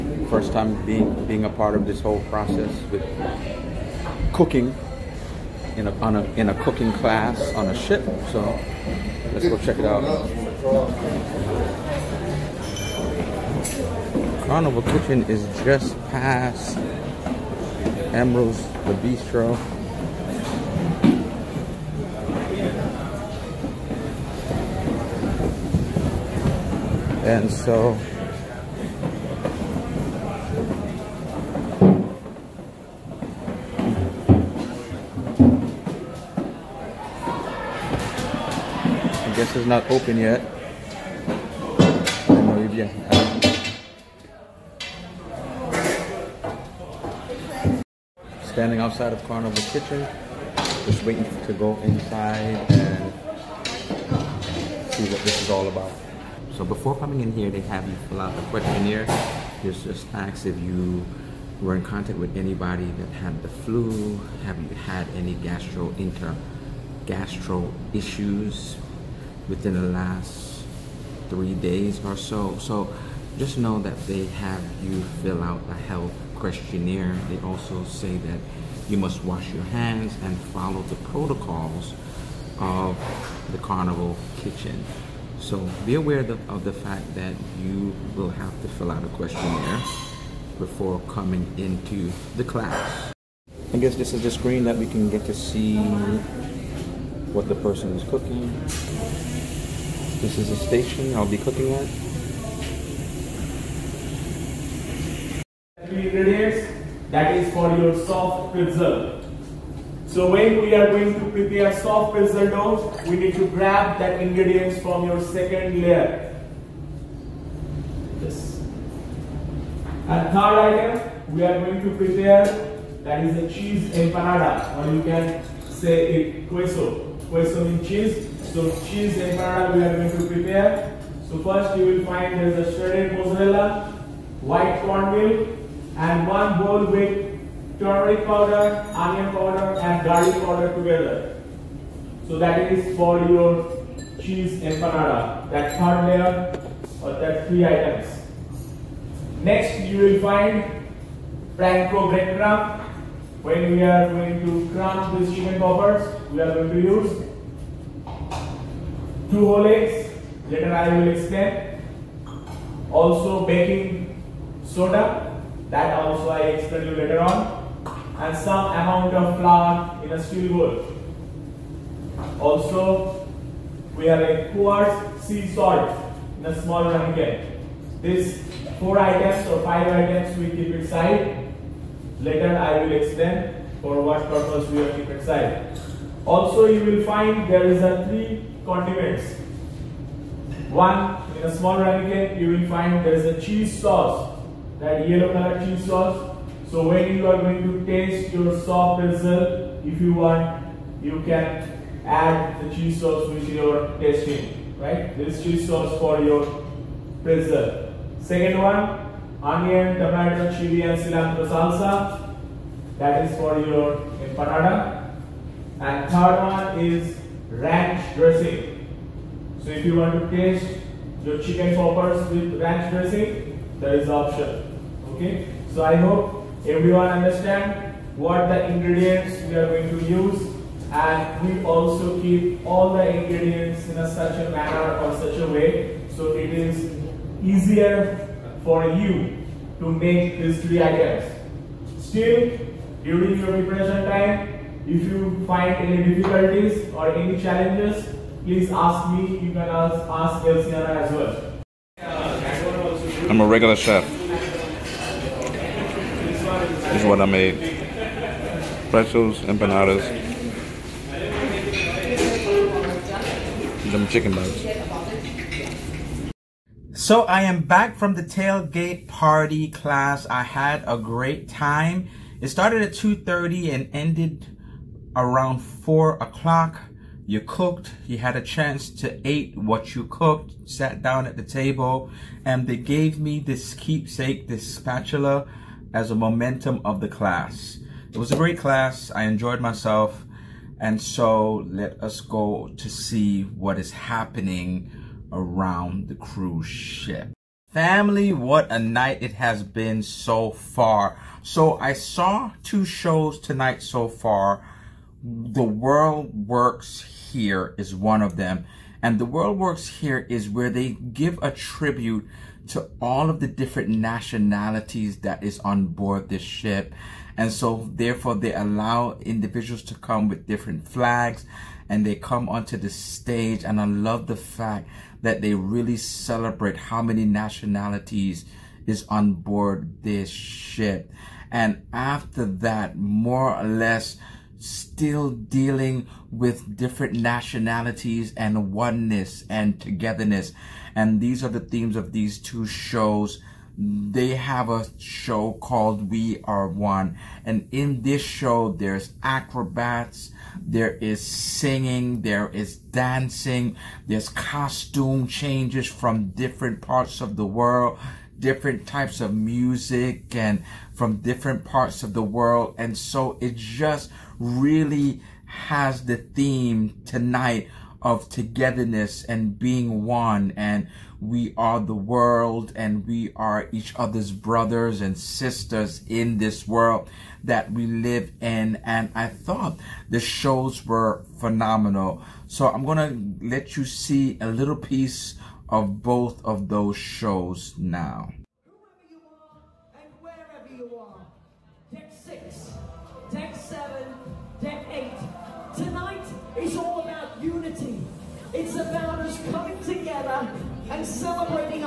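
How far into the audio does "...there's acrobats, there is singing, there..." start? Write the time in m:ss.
5:48.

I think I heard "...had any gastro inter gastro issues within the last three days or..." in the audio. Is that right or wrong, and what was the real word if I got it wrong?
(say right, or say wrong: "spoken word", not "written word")
right.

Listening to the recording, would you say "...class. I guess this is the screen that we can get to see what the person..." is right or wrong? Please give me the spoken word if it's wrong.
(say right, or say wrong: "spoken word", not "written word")
right.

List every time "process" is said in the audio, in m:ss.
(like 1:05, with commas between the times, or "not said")
0:02.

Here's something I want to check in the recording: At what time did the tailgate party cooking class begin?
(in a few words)
2:30.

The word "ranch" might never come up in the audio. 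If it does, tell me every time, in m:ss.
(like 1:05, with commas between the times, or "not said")
3:37, 3:42.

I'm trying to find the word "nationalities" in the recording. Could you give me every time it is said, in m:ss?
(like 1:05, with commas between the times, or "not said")
5:13, 5:27, 5:37.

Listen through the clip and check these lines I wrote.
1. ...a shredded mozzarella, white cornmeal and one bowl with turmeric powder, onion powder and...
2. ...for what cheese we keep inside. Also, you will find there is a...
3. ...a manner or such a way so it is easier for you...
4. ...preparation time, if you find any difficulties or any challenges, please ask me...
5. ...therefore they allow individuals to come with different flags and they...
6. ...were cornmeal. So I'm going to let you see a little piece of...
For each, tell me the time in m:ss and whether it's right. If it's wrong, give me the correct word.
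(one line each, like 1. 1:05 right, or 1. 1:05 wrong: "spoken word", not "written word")
1. 2:12 right
2. 3:03 wrong: "purpose", not "cheese"
3. 3:54 right
4. 4:03 right
5. 5:17 right
6. 6:20 wrong: "phenomenal", not "cornmeal".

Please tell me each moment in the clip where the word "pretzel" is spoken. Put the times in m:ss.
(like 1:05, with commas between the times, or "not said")
1:52, 3:19, 3:27, 4:18.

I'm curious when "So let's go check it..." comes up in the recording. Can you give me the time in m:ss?
0:08.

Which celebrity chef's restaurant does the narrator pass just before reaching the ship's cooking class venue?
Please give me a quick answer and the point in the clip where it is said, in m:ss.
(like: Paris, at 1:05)
Emeril's, at 0:18.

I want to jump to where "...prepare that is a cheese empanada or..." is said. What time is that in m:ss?
2:01.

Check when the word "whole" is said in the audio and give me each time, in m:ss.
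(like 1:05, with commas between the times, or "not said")
0:02, 2:39.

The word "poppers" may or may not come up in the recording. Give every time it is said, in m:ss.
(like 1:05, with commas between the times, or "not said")
2:35, 3:41.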